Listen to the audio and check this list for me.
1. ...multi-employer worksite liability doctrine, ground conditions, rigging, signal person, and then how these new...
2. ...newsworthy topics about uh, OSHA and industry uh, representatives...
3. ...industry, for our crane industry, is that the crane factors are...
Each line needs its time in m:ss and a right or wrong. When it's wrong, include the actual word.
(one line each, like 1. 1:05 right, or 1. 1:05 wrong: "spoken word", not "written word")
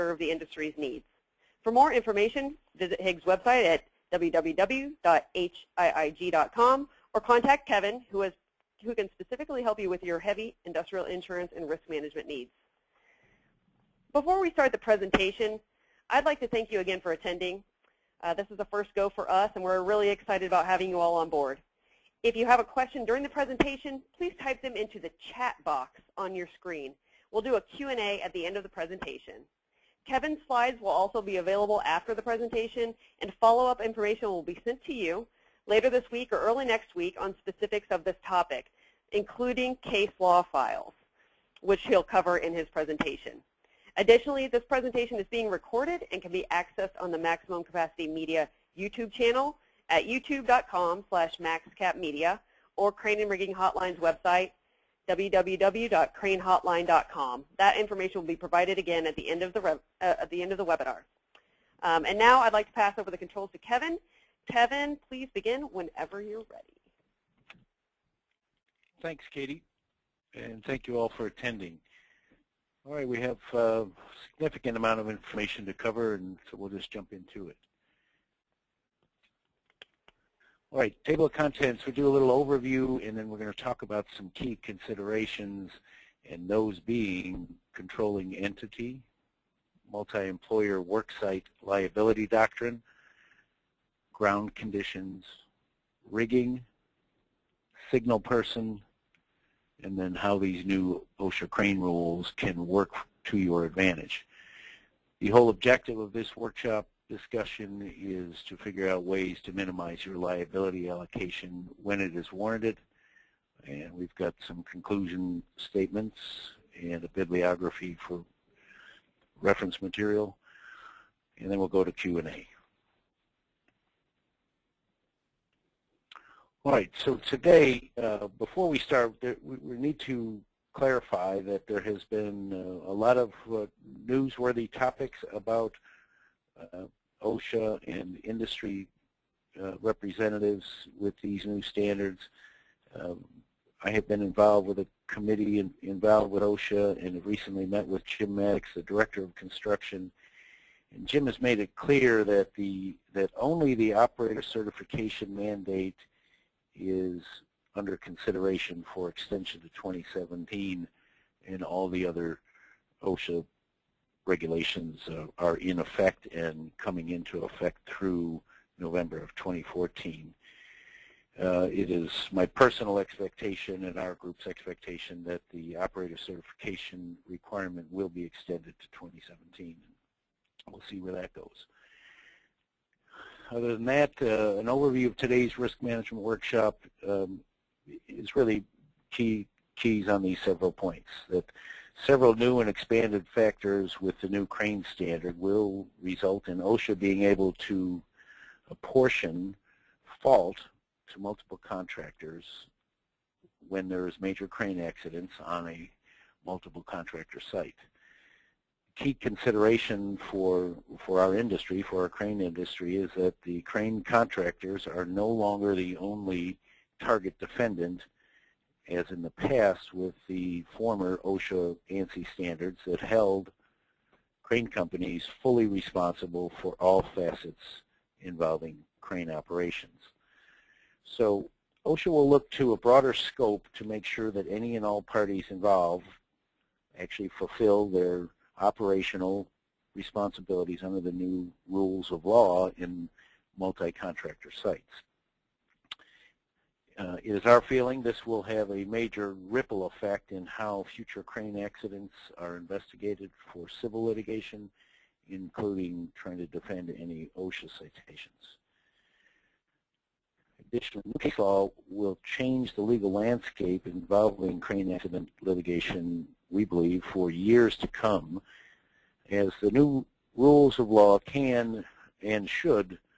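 1. 1:29 right
2. 2:14 right
3. 3:31 wrong: "contractors", not "factors".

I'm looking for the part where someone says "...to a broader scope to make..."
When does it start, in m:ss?
3:52.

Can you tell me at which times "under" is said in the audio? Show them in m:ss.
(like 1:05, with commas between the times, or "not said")
2:37, 4:00.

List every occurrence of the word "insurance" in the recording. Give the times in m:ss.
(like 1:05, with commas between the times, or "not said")
0:11.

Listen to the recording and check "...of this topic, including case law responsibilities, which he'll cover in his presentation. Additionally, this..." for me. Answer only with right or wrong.
wrong.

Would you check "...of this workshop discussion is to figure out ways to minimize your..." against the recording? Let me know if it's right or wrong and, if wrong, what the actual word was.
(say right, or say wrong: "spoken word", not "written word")
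right.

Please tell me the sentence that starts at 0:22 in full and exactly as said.
If you have a question during the presentation, please type them into the chat box on your screen.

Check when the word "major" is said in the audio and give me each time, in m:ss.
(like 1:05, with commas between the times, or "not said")
3:24, 4:08.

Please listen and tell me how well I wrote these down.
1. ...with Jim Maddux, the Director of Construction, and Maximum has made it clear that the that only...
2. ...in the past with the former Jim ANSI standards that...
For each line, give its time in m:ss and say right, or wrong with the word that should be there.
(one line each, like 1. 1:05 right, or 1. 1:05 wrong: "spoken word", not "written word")
1. 2:27 wrong: "Jim", not "Maximum"
2. 3:39 wrong: "OSHA", not "Jim".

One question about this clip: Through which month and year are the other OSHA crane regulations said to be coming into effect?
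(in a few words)
November 2014.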